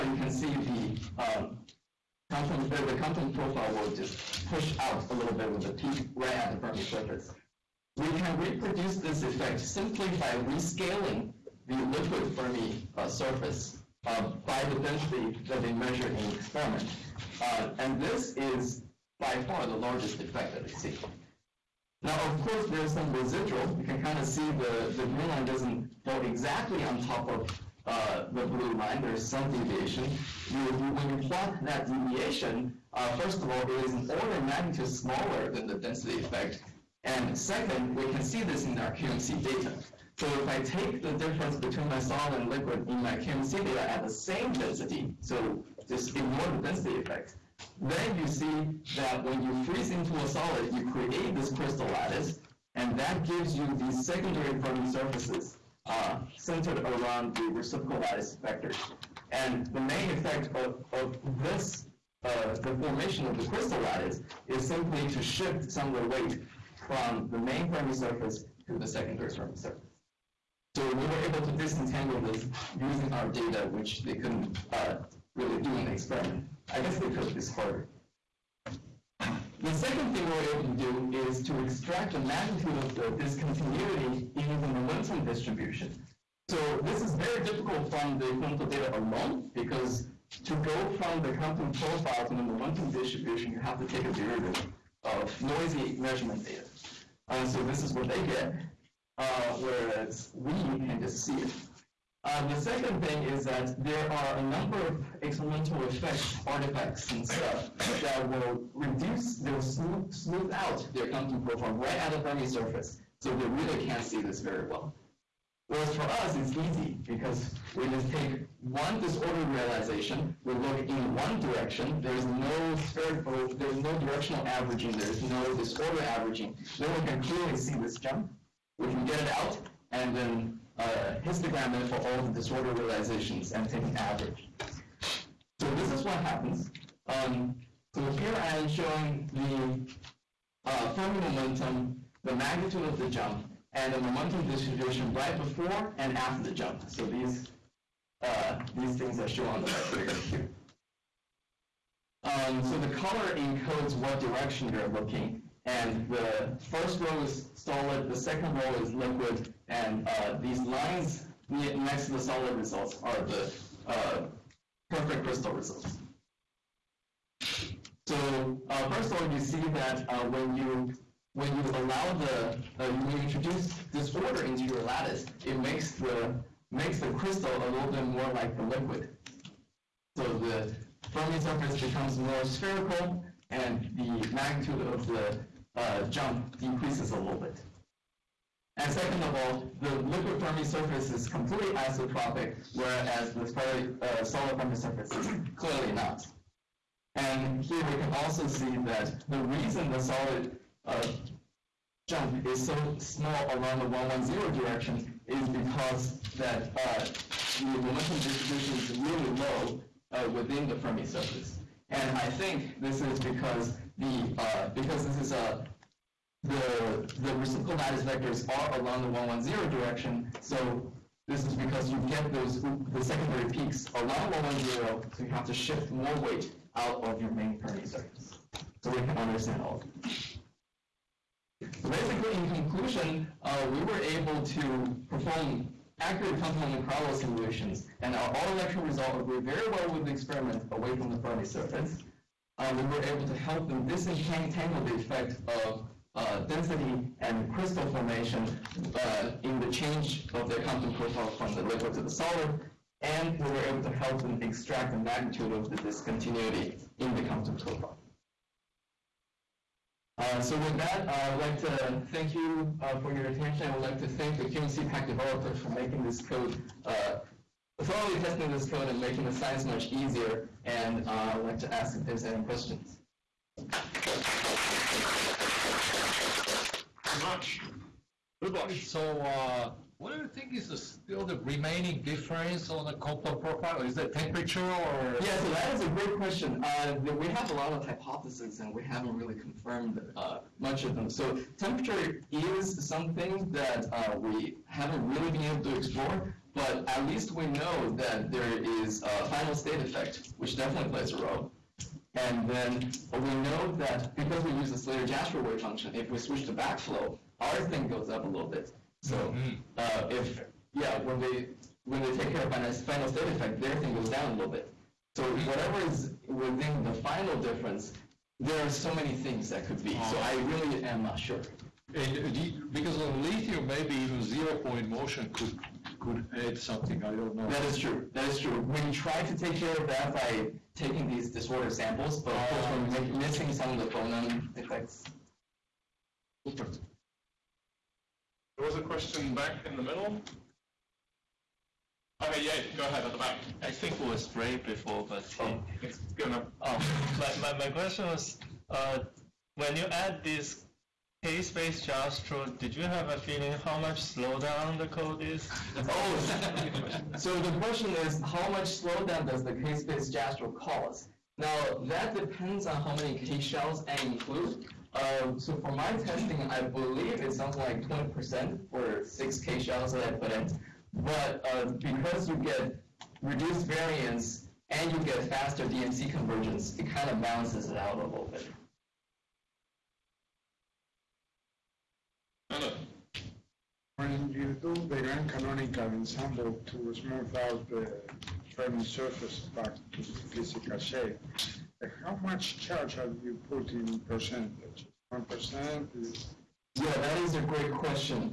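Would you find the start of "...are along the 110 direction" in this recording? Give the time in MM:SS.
03:38.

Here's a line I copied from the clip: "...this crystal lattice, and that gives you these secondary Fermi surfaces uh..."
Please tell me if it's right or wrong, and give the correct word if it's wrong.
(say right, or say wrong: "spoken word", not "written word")
right.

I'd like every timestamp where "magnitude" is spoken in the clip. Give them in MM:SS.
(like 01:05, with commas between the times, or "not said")
00:34, 01:22, 02:22, 03:04, 04:14.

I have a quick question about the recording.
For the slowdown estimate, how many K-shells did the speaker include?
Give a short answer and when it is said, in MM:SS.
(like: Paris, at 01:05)
6, at 06:09.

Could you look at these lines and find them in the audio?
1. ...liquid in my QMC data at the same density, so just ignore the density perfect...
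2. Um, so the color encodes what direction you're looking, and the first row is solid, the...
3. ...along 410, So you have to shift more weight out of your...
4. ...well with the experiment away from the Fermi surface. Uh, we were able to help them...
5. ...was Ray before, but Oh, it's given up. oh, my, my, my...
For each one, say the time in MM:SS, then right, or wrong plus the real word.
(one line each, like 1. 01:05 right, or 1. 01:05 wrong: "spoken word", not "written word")
1. 00:42 wrong: "effect", not "perfect"
2. 02:32 right
3. 03:43 wrong: "110", not "410"
4. 03:59 right
5. 05:44 right.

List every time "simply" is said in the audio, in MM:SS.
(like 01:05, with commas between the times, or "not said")
00:09, 01:04.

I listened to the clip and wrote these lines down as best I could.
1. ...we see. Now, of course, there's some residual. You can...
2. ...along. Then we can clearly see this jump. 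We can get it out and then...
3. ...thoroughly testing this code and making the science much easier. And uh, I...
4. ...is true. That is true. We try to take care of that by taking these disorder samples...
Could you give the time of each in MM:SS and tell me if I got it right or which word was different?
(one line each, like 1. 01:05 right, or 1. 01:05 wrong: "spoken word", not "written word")
1. 00:20 right
2. 02:06 wrong: "averaging", not "along"
3. 04:27 right
4. 05:27 right.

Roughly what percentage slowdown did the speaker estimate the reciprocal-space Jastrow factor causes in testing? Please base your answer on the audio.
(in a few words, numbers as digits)
20%.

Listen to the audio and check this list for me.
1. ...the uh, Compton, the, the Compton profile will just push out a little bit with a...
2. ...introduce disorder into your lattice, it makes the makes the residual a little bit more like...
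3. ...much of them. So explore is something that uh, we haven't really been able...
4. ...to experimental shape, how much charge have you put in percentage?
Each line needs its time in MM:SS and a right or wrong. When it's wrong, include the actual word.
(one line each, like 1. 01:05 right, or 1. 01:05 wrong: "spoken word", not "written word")
1. 00:00 right
2. 02:53 wrong: "crystal", not "residual"
3. 04:50 wrong: "temperature", not "explore"
4. 06:29 wrong: "physical", not "experimental".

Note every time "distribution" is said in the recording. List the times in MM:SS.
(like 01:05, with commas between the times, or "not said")
01:25, 01:32, 02:24, 03:28.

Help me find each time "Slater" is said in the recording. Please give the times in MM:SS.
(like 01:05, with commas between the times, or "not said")
05:04.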